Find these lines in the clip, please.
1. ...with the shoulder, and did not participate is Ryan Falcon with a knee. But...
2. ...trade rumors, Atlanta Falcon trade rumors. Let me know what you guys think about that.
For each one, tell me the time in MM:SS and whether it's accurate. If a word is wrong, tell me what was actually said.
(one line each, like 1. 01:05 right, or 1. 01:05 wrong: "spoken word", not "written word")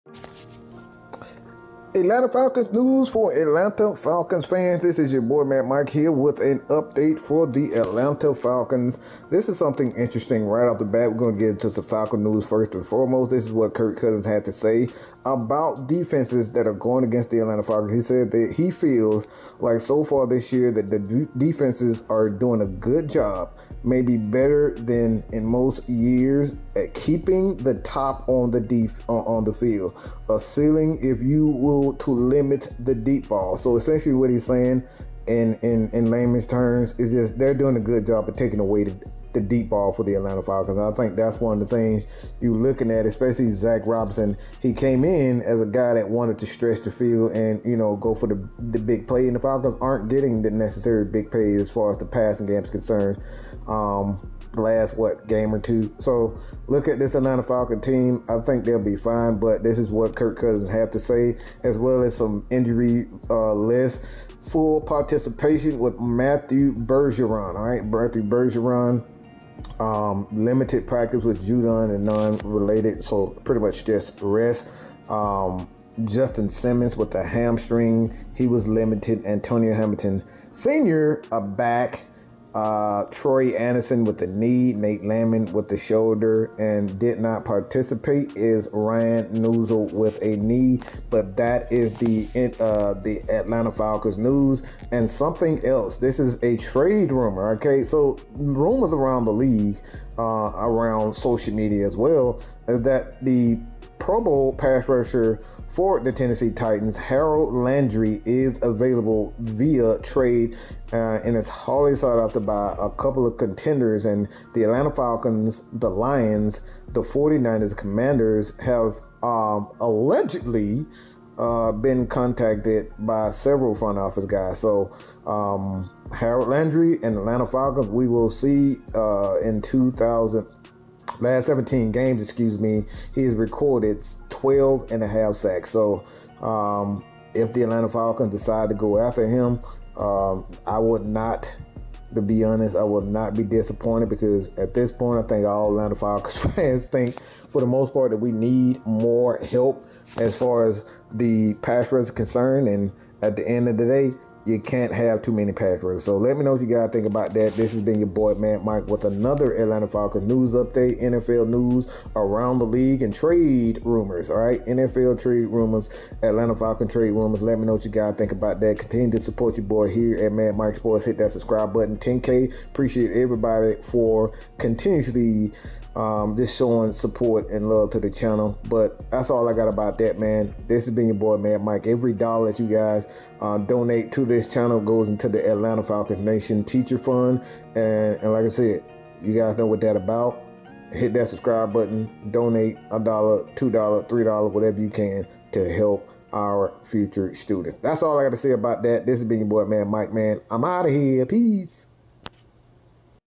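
1. 01:25 wrong: "Neuzil", not "Falcon"
2. 02:45 right.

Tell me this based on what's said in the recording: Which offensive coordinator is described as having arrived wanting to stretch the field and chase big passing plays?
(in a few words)
Zac Robinson.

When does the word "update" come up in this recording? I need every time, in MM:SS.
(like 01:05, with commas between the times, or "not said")
00:06, 02:40.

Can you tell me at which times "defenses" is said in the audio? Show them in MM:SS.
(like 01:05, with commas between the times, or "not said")
00:15, 00:21.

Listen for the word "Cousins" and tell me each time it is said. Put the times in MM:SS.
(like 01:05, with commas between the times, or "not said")
00:13, 01:00.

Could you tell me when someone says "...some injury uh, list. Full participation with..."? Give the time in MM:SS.
01:02.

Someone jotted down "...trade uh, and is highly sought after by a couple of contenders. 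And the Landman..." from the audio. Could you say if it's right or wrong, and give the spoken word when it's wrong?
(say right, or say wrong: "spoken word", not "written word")
wrong: "Atlanta", not "Landman".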